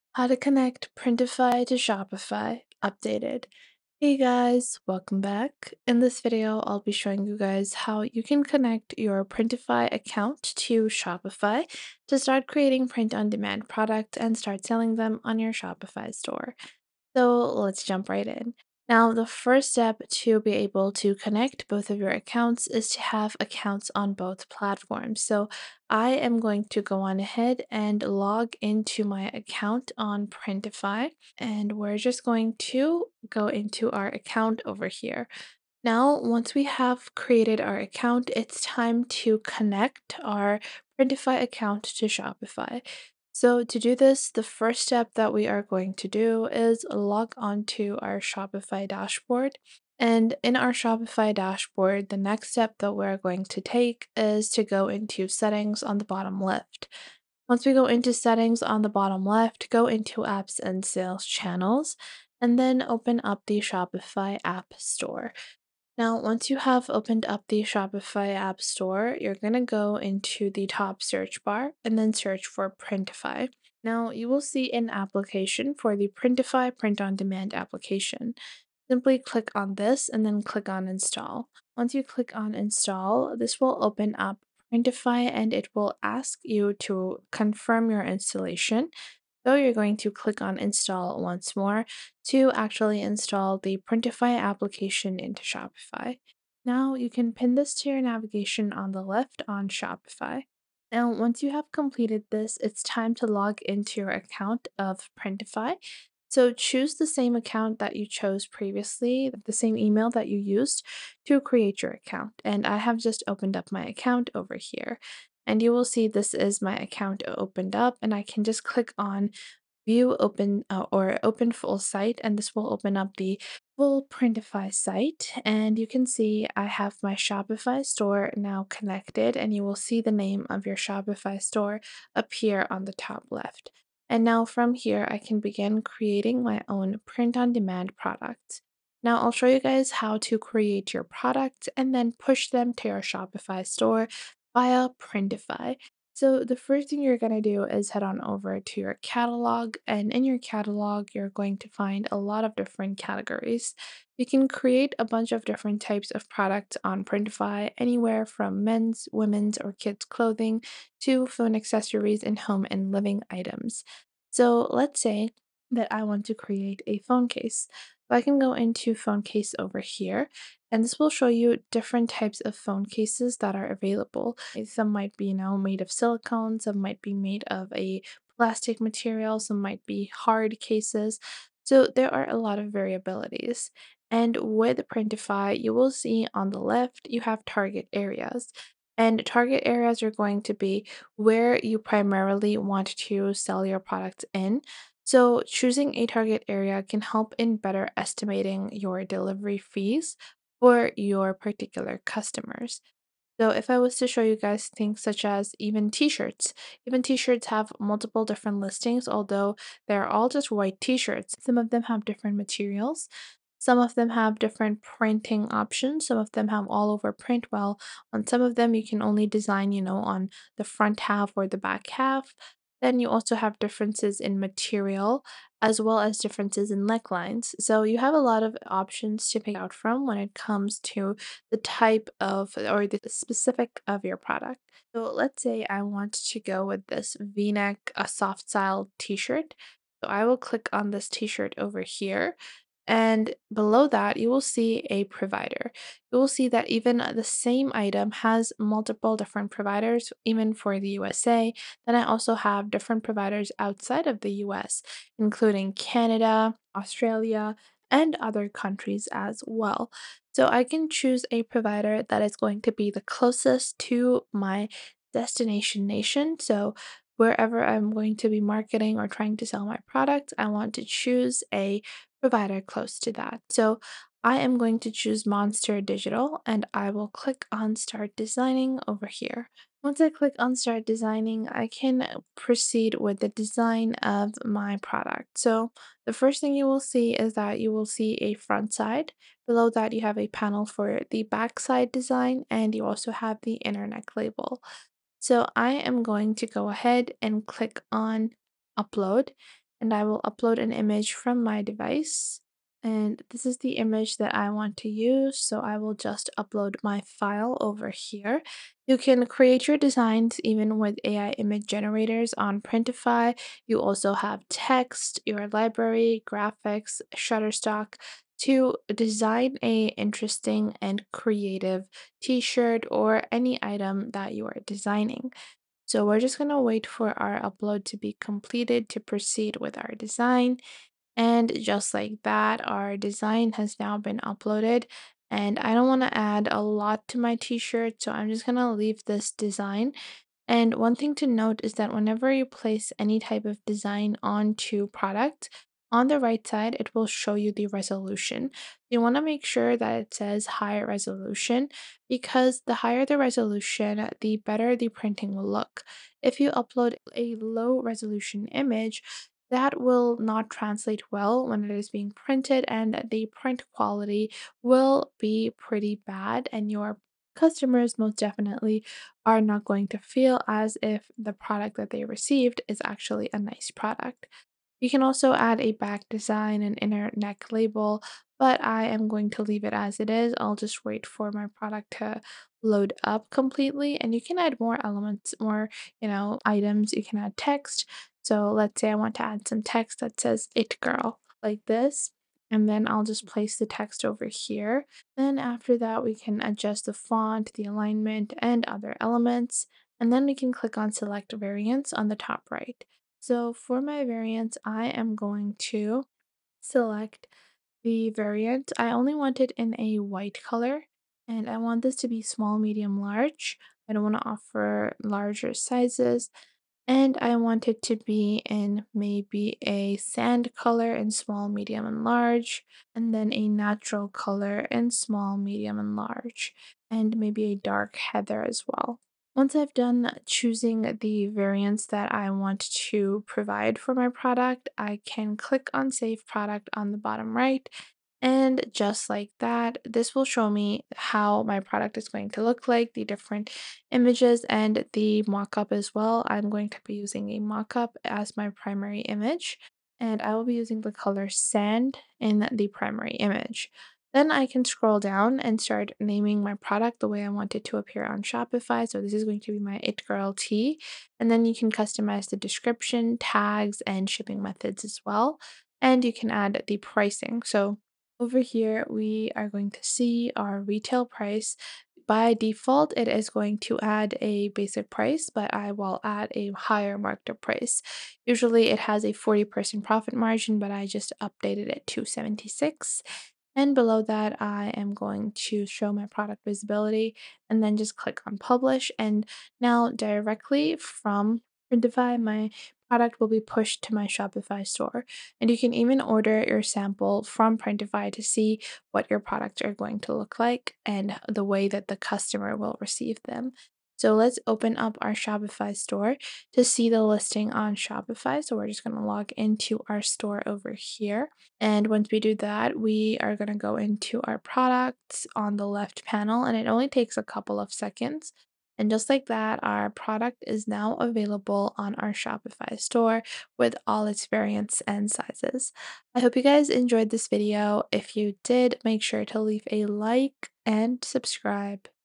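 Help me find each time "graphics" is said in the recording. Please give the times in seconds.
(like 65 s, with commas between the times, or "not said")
316 s.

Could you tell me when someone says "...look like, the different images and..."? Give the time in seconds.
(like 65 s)
442 s.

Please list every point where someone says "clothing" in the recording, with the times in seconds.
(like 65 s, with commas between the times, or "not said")
160 s.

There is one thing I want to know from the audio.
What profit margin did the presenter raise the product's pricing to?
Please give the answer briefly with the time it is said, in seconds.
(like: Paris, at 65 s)
76, at 482 s.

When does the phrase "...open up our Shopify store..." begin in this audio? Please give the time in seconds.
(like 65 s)
504 s.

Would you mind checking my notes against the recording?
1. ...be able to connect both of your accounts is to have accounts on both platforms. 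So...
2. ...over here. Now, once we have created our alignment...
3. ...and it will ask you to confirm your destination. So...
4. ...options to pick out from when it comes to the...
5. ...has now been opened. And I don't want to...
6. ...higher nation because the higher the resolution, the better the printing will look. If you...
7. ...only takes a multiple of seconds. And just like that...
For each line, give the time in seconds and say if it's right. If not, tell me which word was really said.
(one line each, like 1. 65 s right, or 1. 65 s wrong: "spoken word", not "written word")
1. 20 s right
2. 34 s wrong: "account", not "alignment"
3. 85 s wrong: "installation", not "destination"
4. 228 s right
5. 333 s wrong: "uploaded", not "opened"
6. 350 s wrong: "resolution", not "nation"
7. 516 s wrong: "couple", not "multiple".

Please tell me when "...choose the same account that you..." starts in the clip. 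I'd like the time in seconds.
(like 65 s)
106 s.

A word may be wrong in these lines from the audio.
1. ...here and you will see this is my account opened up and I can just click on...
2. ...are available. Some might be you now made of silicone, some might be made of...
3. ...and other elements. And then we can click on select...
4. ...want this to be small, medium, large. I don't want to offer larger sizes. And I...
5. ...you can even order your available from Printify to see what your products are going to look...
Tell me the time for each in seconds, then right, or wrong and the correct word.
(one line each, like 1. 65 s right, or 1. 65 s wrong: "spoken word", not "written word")
1. 114 s right
2. 173 s right
3. 398 s right
4. 411 s right
5. 495 s wrong: "sample", not "available".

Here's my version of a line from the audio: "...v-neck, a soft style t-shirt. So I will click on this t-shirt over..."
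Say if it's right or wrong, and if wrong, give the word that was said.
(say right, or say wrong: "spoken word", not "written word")
right.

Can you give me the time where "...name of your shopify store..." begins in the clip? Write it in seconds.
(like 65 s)
130 s.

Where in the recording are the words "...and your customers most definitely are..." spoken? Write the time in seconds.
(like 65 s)
366 s.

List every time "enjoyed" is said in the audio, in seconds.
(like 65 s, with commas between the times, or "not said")
526 s.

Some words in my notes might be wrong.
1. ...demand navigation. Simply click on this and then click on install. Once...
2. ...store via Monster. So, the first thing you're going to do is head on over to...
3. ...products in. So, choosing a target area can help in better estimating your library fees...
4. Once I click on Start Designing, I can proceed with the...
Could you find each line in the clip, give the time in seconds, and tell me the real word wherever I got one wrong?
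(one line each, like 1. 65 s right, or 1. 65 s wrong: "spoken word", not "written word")
1. 77 s wrong: "application", not "navigation"
2. 143 s wrong: "Printify", not "Monster"
3. 193 s wrong: "delivery", not "library"
4. 279 s right.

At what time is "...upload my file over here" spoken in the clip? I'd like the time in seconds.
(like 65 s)
306 s.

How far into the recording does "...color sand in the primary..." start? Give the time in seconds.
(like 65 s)
450 s.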